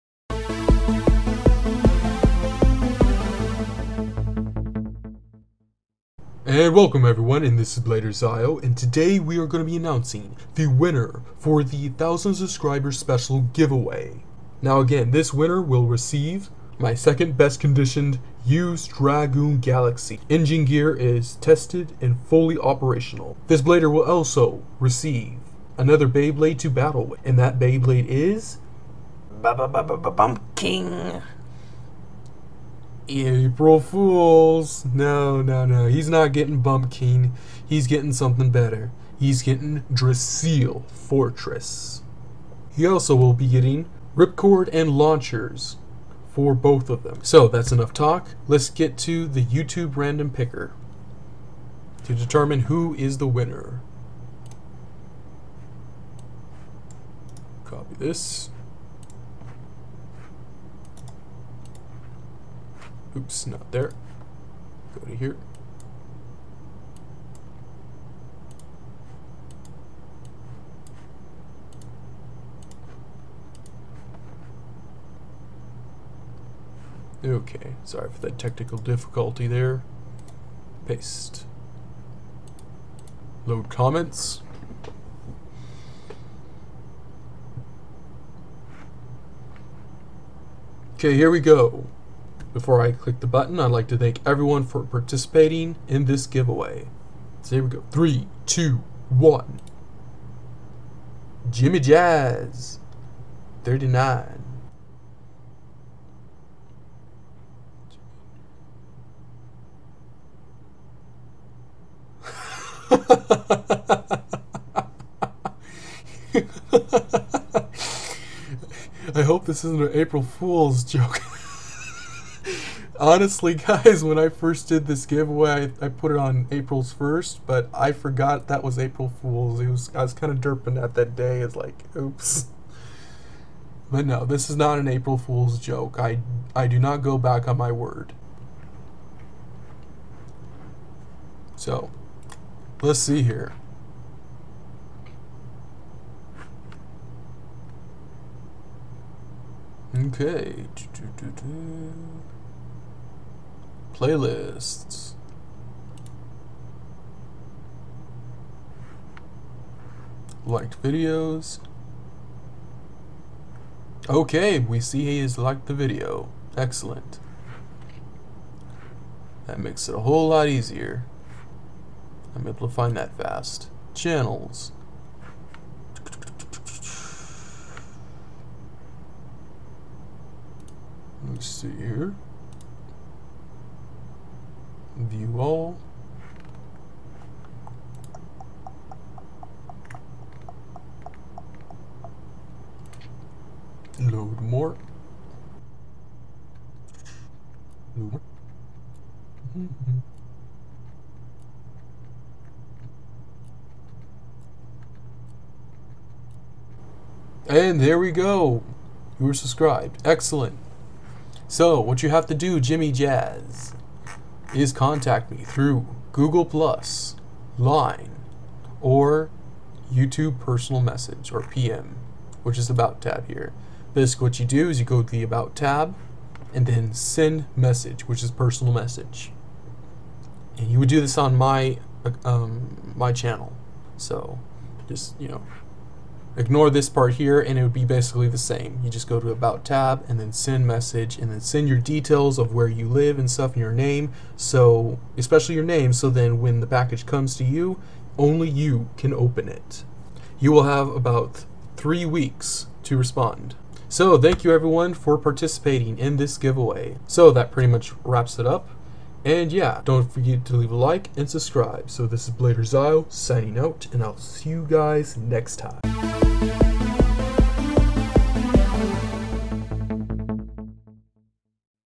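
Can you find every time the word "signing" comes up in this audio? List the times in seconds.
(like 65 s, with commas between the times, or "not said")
263 s.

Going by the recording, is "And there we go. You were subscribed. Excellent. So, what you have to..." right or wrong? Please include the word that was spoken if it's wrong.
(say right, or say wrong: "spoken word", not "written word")
right.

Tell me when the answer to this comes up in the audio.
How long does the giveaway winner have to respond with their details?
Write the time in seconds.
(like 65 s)
251 s.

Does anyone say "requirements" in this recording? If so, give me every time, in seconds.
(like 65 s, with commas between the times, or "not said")
not said.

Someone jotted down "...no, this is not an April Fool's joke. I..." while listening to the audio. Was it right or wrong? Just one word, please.
right.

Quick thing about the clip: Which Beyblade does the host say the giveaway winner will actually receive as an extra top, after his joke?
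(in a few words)
Drasil Fortress.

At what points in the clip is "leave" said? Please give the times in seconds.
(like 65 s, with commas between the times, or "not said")
260 s.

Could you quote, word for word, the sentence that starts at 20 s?
Engine gear is tested and fully operational.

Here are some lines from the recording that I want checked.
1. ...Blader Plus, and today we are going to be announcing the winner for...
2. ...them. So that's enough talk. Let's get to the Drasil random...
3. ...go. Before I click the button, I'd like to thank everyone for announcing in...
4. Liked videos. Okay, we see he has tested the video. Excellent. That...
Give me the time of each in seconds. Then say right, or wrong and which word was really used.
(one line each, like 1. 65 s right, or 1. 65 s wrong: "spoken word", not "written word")
1. 7 s wrong: "ZYeYO", not "Plus"
2. 47 s wrong: "YouTube", not "Drasil"
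3. 91 s wrong: "participating", not "announcing"
4. 160 s wrong: "liked", not "tested".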